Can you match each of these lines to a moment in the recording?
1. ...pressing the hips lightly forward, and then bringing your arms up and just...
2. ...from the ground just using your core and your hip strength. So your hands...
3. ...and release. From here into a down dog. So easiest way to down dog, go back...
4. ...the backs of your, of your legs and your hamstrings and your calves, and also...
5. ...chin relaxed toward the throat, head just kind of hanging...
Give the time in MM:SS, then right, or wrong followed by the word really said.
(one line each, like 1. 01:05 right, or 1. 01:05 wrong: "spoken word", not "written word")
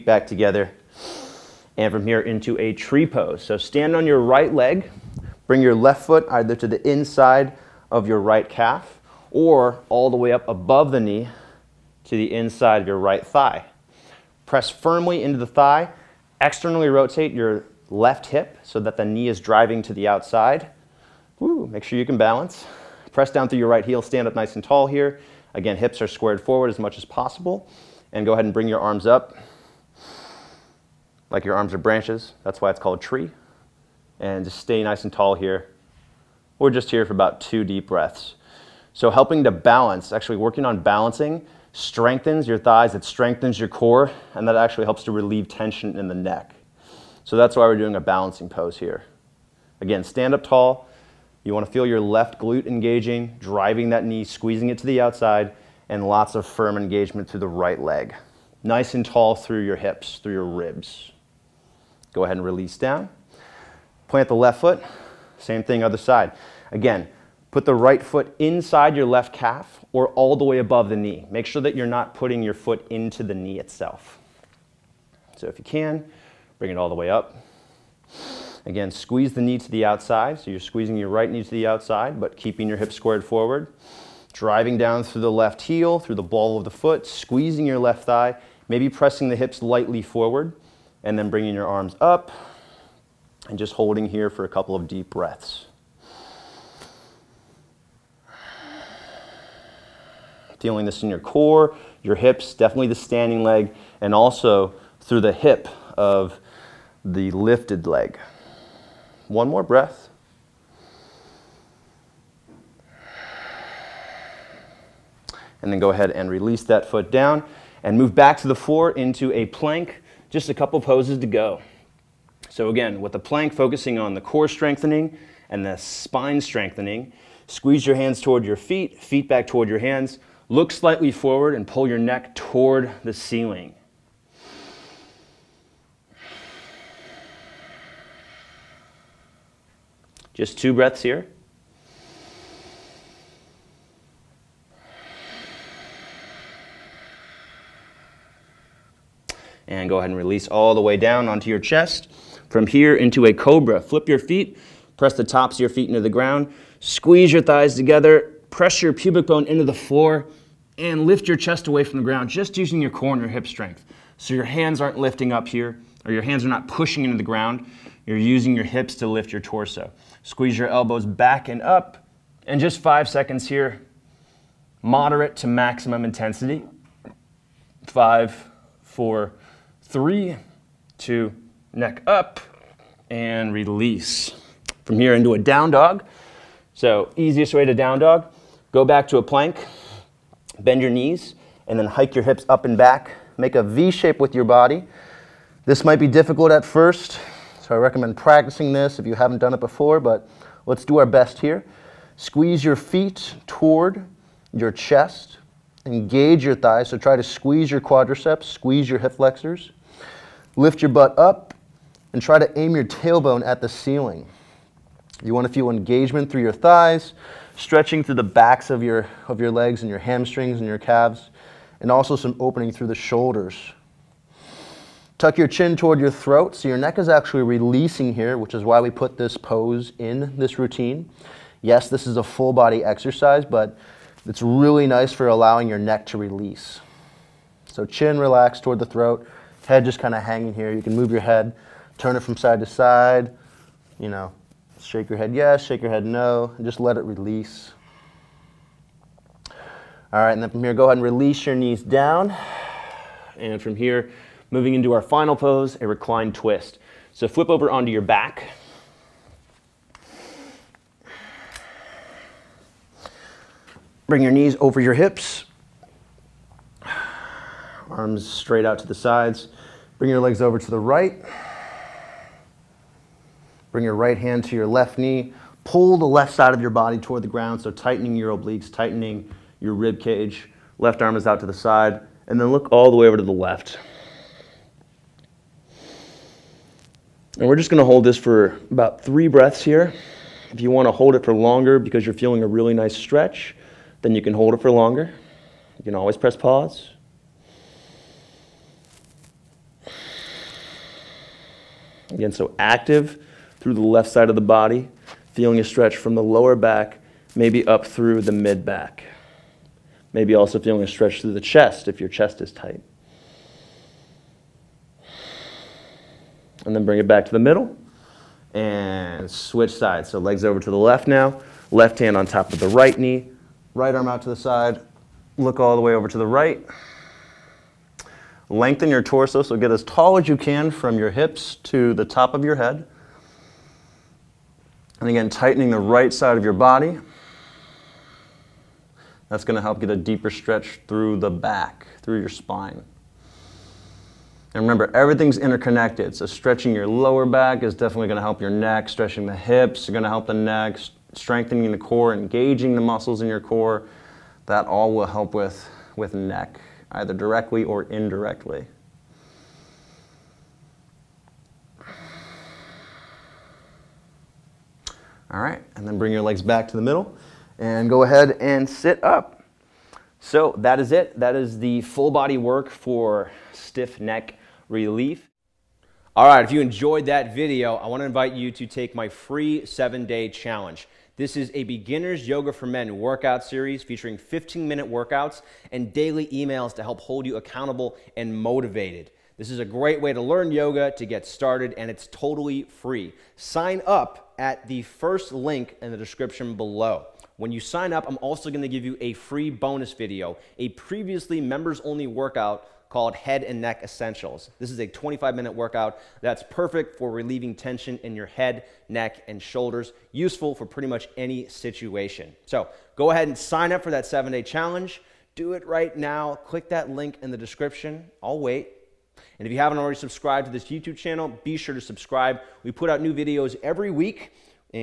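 1. 01:28 right
2. 02:41 right
3. 03:03 right
4. 03:38 right
5. 03:57 right.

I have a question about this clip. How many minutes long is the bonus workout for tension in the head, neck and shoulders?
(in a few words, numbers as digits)
25.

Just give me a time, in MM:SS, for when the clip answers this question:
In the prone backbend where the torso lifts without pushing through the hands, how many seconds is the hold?
02:52.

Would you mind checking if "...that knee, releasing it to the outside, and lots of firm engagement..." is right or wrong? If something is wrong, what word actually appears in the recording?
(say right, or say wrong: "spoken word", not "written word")
wrong: "squeezing", not "releasing".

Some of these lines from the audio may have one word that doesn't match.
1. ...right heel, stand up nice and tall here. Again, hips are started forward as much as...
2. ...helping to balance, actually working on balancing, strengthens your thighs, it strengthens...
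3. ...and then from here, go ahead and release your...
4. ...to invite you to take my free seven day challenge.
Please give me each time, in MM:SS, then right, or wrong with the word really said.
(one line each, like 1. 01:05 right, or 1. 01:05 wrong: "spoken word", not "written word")
1. 00:23 wrong: "squared", not "started"
2. 00:39 right
3. 04:10 right
4. 06:18 right.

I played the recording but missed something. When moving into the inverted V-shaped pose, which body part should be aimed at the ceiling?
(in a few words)
tailbone.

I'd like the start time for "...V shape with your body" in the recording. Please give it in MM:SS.
03:13.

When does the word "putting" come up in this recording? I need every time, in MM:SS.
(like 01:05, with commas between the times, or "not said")
01:12.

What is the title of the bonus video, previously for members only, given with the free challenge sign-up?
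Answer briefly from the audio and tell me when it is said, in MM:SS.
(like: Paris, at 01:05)
Head and Neck Essentials, at 06:43.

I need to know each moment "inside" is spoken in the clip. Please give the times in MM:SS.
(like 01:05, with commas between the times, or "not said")
00:06, 00:12, 01:08.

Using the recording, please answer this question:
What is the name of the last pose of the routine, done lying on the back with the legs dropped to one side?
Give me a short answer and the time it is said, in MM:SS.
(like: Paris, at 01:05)
reclined twist, at 04:15.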